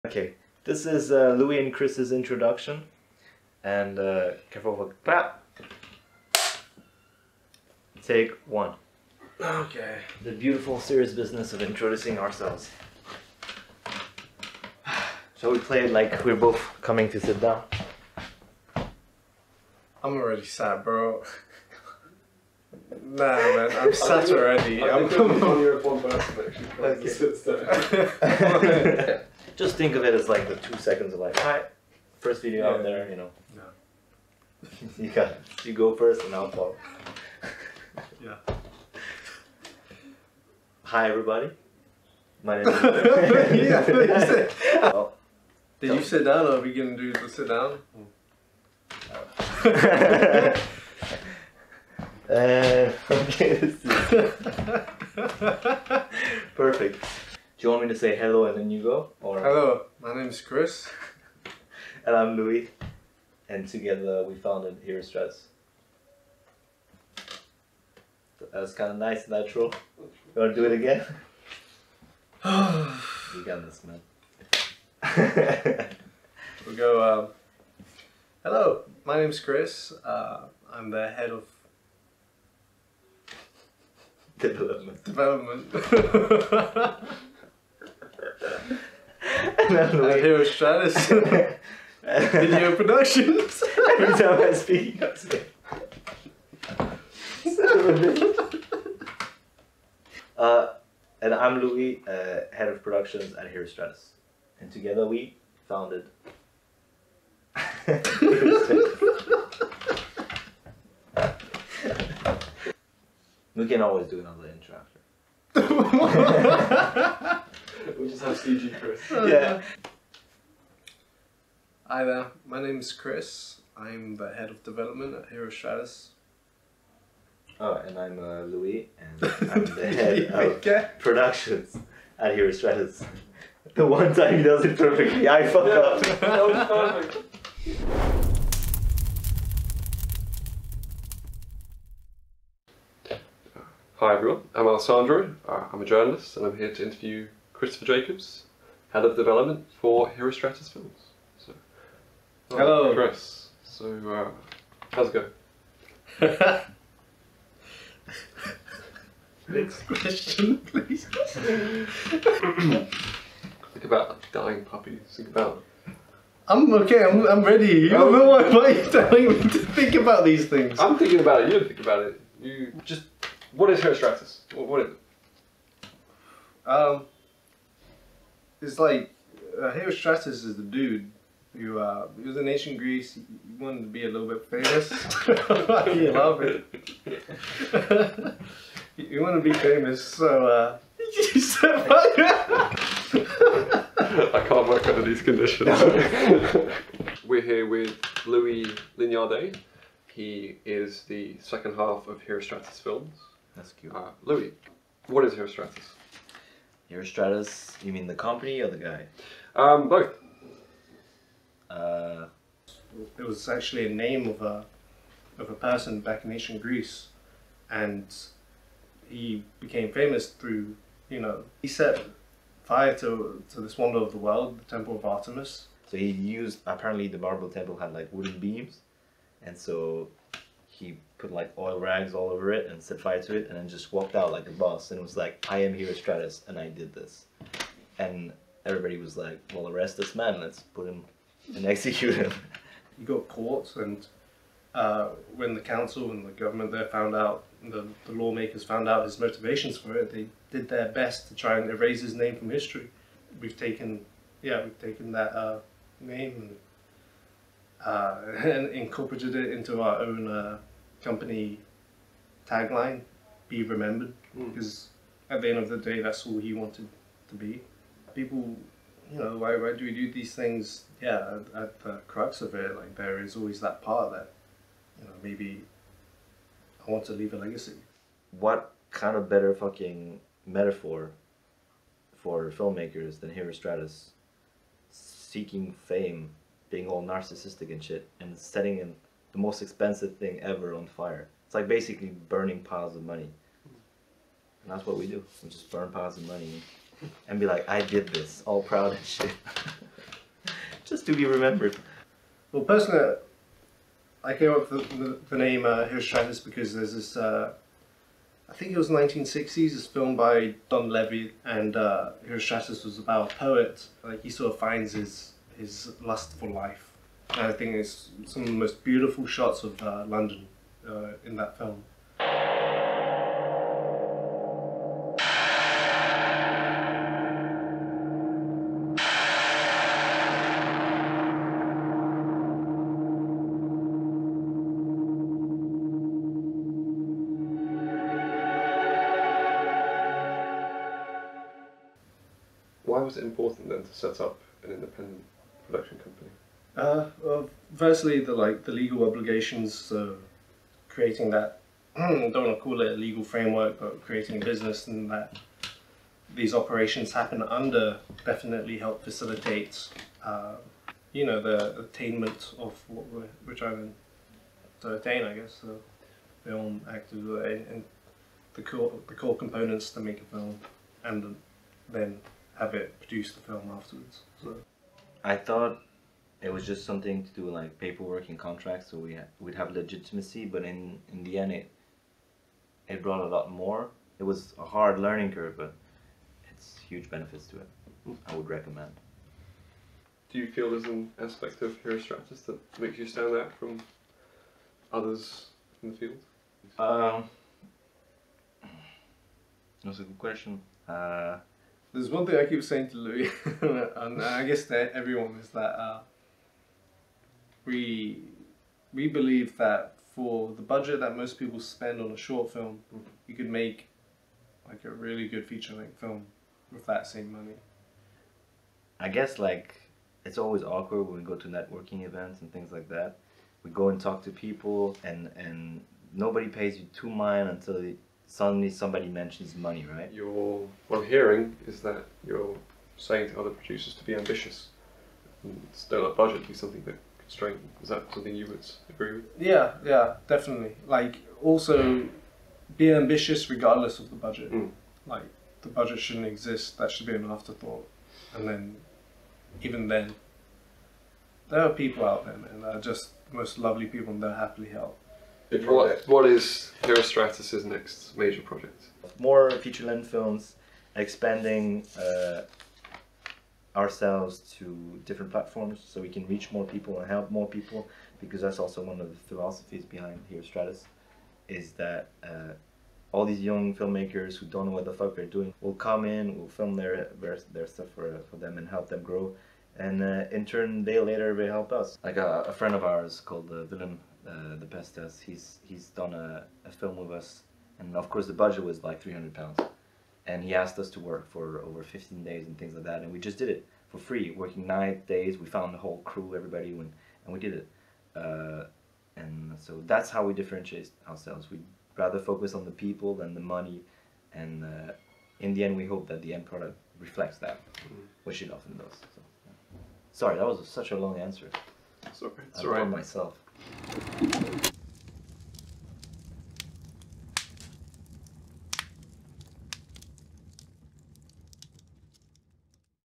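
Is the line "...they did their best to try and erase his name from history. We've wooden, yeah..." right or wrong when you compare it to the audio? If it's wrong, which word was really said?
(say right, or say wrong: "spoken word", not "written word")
wrong: "taken", not "wooden".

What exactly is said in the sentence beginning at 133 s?
The one time he does it perfectly, I fuck yeah.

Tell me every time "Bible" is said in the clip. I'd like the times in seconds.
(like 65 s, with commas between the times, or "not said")
not said.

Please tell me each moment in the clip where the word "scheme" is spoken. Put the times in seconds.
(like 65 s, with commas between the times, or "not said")
not said.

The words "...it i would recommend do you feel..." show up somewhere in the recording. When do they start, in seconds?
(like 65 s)
387 s.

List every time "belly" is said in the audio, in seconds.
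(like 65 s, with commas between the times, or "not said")
not said.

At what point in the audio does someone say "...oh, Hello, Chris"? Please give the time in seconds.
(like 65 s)
152 s.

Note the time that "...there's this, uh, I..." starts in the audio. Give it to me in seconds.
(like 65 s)
306 s.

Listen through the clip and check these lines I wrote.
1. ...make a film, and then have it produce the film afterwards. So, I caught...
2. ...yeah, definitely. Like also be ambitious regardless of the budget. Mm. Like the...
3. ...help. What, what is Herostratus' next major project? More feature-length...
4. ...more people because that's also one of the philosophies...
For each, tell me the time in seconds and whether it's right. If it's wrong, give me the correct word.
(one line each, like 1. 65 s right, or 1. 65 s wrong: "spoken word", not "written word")
1. 369 s wrong: "thought", not "caught"
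2. 439 s right
3. 454 s right
4. 467 s right.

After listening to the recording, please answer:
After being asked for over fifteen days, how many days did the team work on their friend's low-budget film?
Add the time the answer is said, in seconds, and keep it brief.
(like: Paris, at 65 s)
9, at 494 s.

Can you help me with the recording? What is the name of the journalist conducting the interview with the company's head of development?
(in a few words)
Alessandro.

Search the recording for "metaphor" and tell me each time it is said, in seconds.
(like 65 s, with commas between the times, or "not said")
280 s.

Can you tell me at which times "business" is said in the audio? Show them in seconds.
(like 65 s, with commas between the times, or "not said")
11 s, 354 s.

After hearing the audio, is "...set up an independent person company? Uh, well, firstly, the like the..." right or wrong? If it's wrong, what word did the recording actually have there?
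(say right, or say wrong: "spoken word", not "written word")
wrong: "production", not "person".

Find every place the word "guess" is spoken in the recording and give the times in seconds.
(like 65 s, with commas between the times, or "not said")
365 s, 404 s, 419 s.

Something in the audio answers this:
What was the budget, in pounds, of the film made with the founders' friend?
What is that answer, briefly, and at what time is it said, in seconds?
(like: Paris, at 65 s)
300 pounds, at 489 s.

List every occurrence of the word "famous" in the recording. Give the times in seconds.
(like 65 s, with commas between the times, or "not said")
184 s, 189 s, 219 s.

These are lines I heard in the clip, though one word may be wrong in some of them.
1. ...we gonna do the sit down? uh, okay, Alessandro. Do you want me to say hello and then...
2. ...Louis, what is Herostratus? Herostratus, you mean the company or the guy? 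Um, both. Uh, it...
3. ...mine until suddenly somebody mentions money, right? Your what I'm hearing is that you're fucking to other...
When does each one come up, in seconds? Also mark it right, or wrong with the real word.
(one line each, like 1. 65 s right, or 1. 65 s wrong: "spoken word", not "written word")
1. 46 s wrong: "Perfect", not "Alessandro"
2. 204 s right
3. 427 s wrong: "saying", not "fucking".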